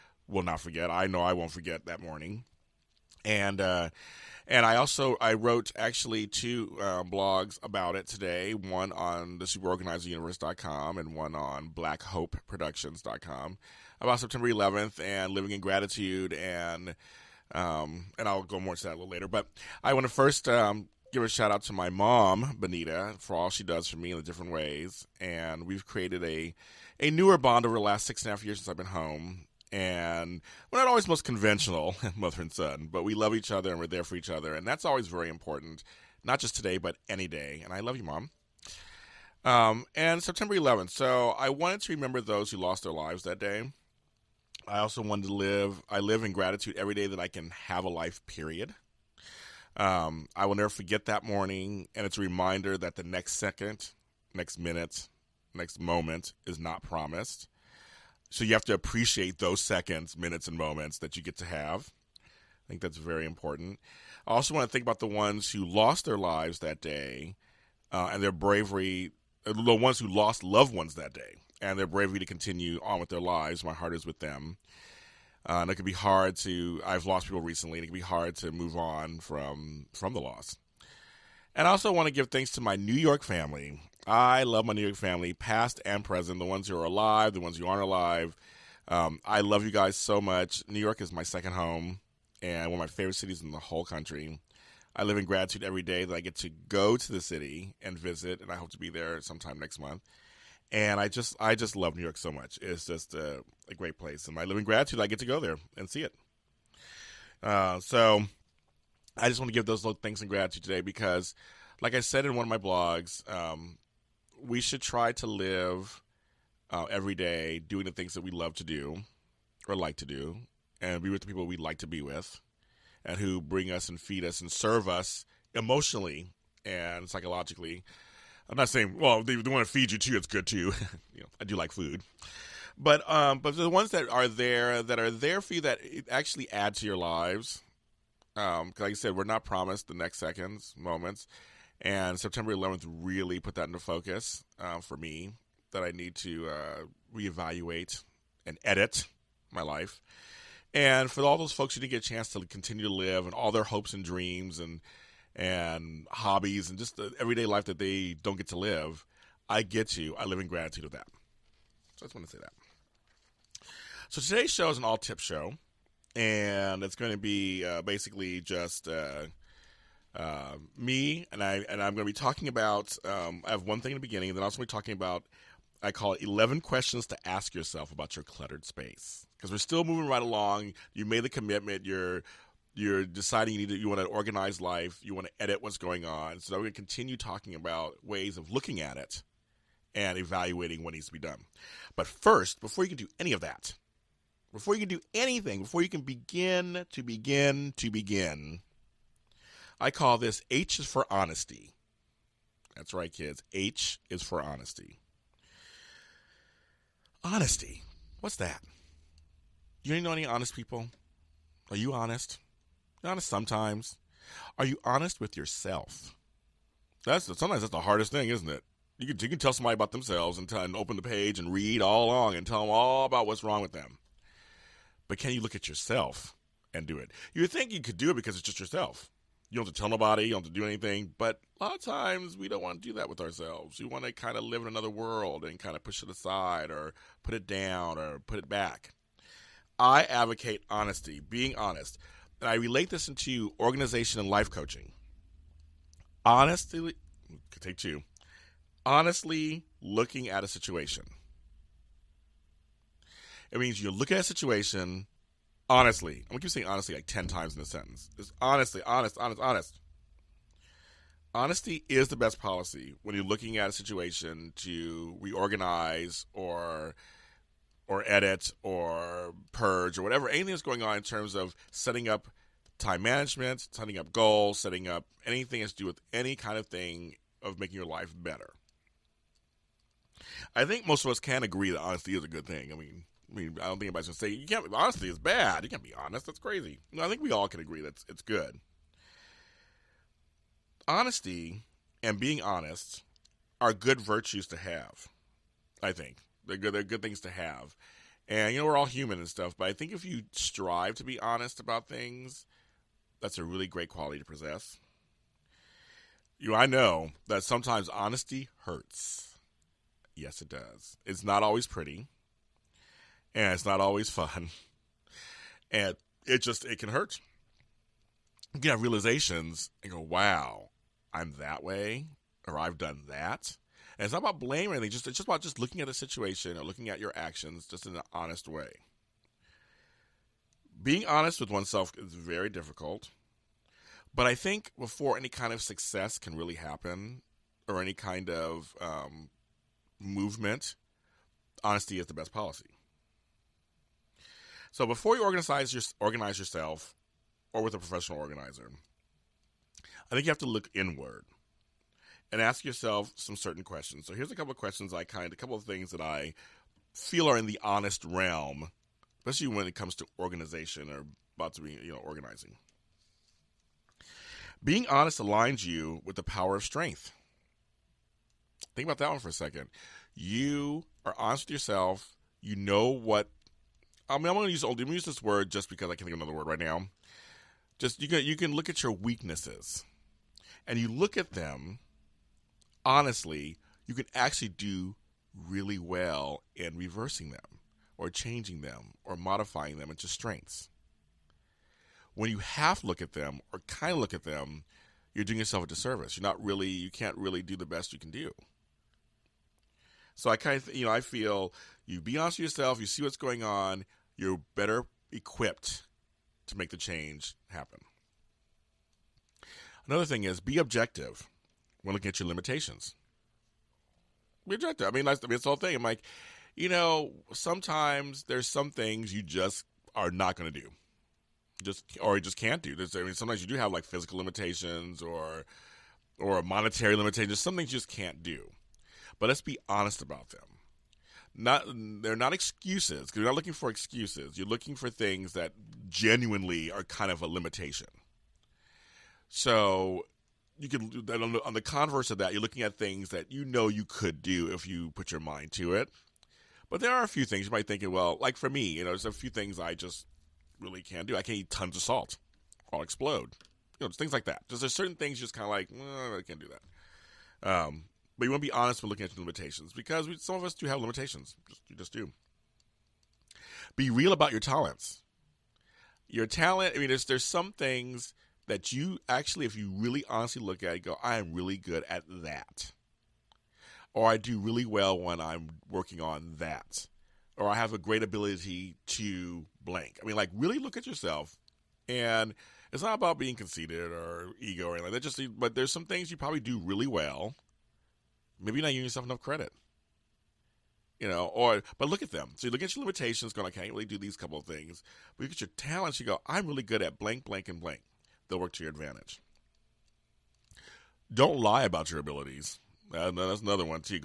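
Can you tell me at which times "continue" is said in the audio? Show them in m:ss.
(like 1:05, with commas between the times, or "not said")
1:12, 2:32, 3:06.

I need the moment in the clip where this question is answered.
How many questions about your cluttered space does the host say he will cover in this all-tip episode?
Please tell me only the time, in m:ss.
2:56.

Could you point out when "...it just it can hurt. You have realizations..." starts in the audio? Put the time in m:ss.
5:16.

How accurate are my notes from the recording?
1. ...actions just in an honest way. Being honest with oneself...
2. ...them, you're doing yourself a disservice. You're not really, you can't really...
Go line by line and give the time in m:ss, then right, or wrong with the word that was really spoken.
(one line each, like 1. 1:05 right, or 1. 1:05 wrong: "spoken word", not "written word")
1. 5:27 right
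2. 6:34 right.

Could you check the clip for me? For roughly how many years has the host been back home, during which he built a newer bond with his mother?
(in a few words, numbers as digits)
6 and a half years.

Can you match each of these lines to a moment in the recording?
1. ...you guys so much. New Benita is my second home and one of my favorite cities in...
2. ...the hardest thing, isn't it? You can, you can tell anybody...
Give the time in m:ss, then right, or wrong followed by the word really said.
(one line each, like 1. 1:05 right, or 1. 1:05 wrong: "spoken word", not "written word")
1. 1:29 wrong: "York", not "Benita"
2. 3:37 wrong: "somebody", not "anybody".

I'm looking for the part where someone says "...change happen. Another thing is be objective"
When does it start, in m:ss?
6:46.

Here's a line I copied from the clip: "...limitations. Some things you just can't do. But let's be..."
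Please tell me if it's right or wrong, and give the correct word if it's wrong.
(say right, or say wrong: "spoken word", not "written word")
right.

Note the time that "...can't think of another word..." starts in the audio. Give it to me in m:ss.
6:15.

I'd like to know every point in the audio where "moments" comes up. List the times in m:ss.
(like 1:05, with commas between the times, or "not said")
0:55, 1:00, 2:20.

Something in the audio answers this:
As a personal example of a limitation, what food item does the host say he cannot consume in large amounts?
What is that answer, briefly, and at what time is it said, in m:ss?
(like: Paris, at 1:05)
salt, at 7:31.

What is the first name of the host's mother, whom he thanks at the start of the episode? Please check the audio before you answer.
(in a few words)
Benita.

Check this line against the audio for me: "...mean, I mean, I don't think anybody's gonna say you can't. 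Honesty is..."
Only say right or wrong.
right.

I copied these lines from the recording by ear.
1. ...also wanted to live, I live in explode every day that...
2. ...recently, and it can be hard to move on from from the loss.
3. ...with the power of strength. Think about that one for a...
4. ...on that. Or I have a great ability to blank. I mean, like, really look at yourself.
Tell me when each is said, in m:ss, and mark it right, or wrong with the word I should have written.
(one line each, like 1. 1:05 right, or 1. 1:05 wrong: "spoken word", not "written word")
1. 0:44 wrong: "gratitude", not "explode"
2. 1:17 right
3. 6:06 right
4. 7:56 right.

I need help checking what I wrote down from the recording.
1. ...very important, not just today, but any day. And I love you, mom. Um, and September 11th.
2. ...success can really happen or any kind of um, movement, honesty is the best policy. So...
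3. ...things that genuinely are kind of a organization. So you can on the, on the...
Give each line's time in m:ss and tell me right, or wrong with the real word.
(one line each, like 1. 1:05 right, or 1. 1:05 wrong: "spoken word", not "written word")
1. 0:35 right
2. 5:35 right
3. 7:14 wrong: "limitation", not "organization".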